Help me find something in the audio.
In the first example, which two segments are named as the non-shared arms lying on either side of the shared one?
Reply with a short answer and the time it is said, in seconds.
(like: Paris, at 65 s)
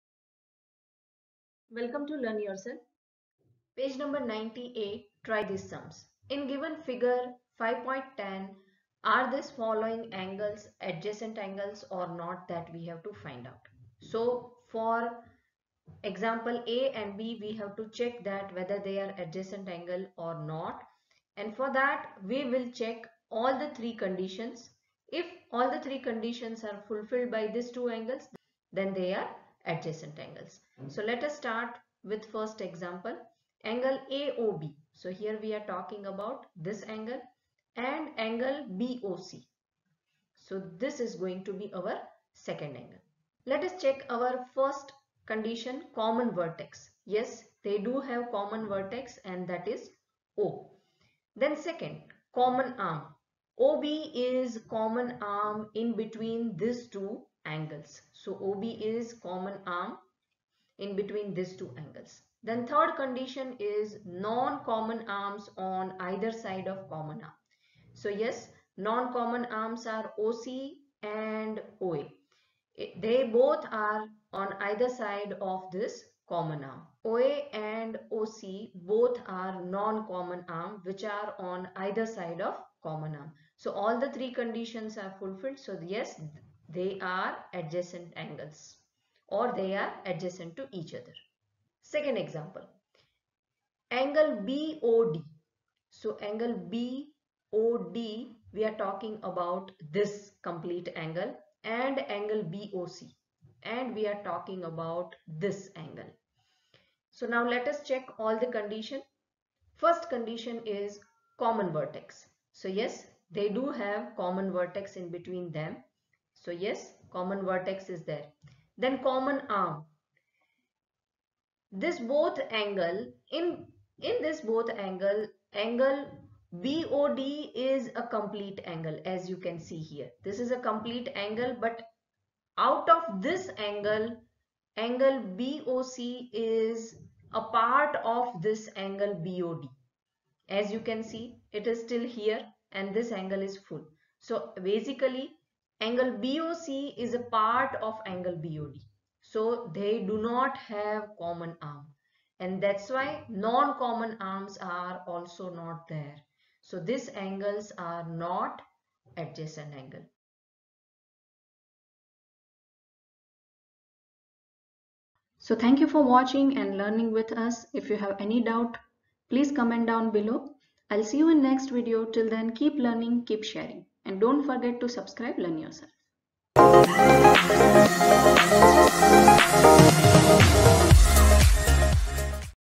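OC and OA, at 70 s.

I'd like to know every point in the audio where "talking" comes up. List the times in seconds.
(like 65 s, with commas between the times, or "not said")
35 s, 98 s, 104 s.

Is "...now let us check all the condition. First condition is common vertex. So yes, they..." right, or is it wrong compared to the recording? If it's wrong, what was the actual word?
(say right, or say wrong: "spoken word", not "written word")
right.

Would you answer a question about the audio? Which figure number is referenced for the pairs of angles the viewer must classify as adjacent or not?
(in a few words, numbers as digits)
5.10.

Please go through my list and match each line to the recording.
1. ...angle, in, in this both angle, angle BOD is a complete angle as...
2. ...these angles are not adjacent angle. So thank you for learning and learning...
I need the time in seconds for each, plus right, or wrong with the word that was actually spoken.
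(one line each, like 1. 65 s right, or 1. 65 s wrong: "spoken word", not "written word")
1. 122 s right
2. 156 s wrong: "watching", not "learning".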